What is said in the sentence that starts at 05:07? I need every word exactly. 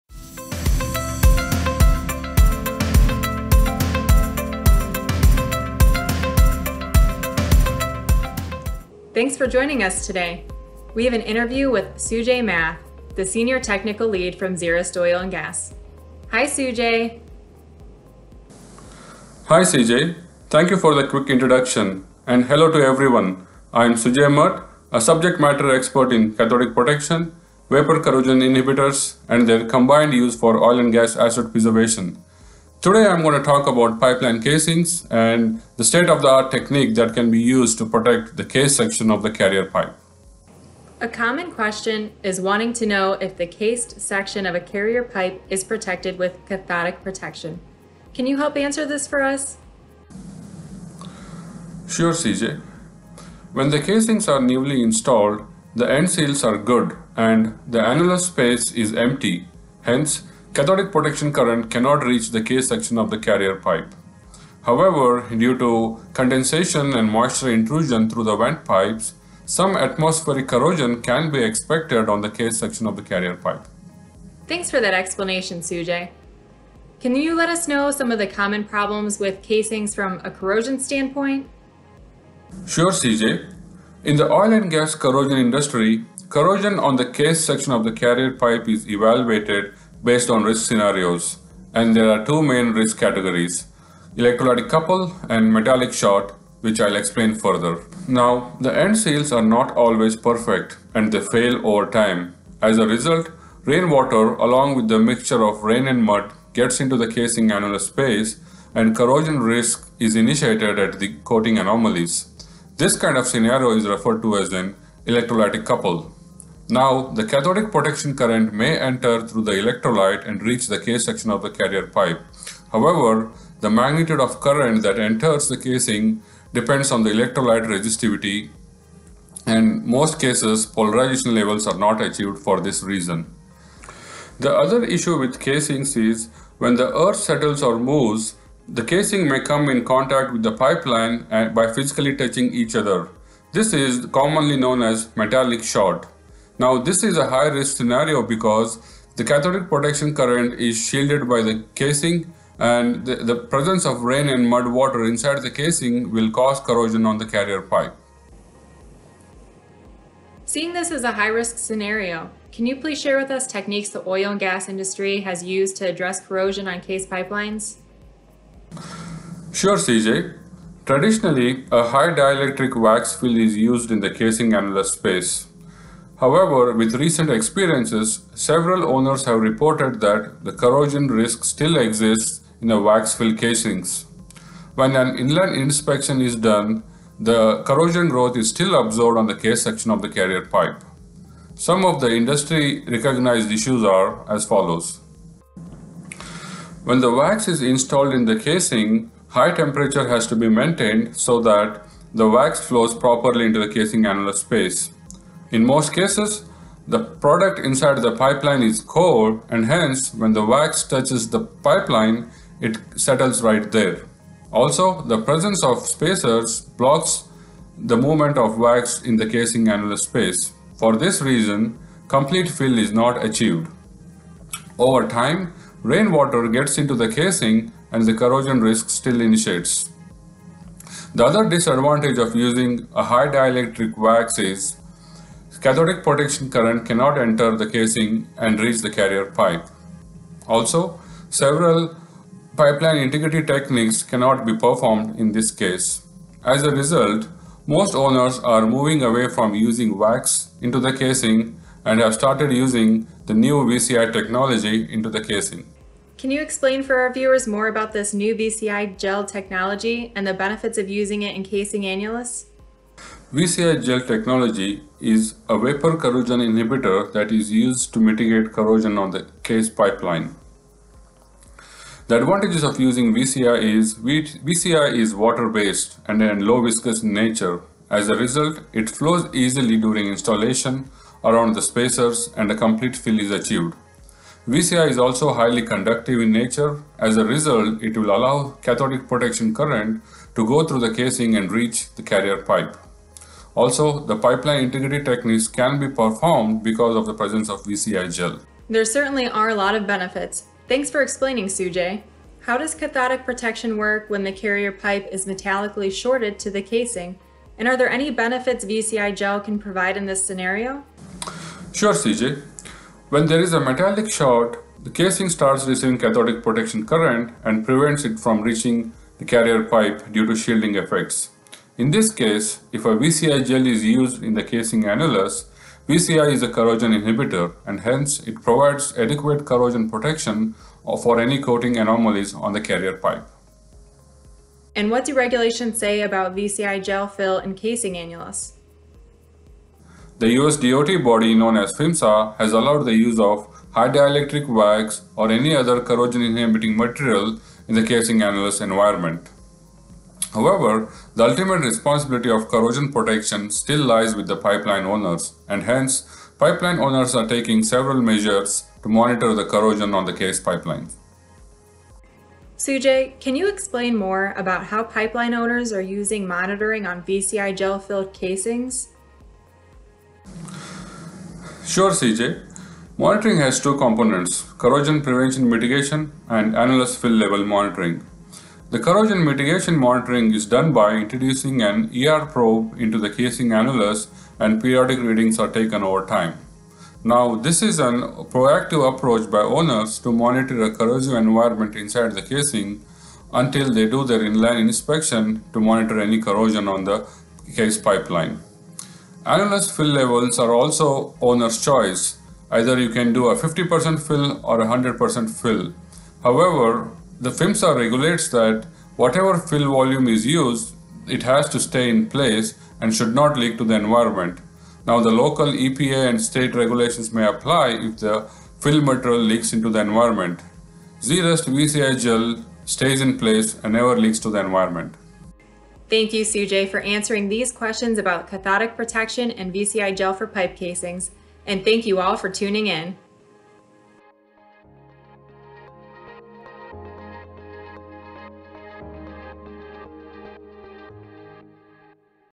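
And are there any benefits VCI gel can provide in this scenario?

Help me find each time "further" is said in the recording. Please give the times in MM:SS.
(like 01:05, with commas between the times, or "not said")
01:37.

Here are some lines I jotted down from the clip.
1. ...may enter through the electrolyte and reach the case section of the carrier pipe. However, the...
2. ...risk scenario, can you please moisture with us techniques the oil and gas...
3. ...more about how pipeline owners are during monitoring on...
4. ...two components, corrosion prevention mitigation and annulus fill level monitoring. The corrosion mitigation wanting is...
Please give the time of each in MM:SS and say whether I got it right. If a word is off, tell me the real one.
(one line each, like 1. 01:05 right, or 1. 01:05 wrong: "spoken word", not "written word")
1. 01:58 right
2. 02:41 wrong: "share", not "moisture"
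3. 06:03 wrong: "using", not "during"
4. 06:13 wrong: "monitoring", not "wanting".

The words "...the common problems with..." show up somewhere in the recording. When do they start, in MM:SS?
01:18.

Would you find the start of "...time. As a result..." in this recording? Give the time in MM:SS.
01:41.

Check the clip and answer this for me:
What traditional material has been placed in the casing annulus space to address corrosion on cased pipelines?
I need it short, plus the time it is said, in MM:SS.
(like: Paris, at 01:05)
high dielectric wax fill, at 02:51.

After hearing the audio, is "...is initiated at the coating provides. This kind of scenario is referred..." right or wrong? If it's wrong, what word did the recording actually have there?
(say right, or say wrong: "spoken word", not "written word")
wrong: "anomalies", not "provides".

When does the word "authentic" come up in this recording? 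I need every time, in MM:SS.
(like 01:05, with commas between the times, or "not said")
not said.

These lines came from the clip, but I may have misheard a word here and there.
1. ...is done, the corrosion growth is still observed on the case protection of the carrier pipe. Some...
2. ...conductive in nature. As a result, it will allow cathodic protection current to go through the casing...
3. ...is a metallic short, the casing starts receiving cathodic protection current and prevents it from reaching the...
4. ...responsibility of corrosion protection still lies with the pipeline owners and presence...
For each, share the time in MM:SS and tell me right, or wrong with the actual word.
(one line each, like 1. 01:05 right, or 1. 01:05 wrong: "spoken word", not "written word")
1. 03:06 wrong: "section", not "protection"
2. 04:45 right
3. 05:13 right
4. 05:51 wrong: "hence", not "presence".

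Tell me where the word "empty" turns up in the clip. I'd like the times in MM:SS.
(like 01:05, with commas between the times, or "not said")
00:58.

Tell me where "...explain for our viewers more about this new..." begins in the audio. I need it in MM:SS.
04:16.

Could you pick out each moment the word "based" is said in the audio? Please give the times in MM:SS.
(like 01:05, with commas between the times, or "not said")
01:30, 04:35.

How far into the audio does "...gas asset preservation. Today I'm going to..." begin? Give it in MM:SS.
00:30.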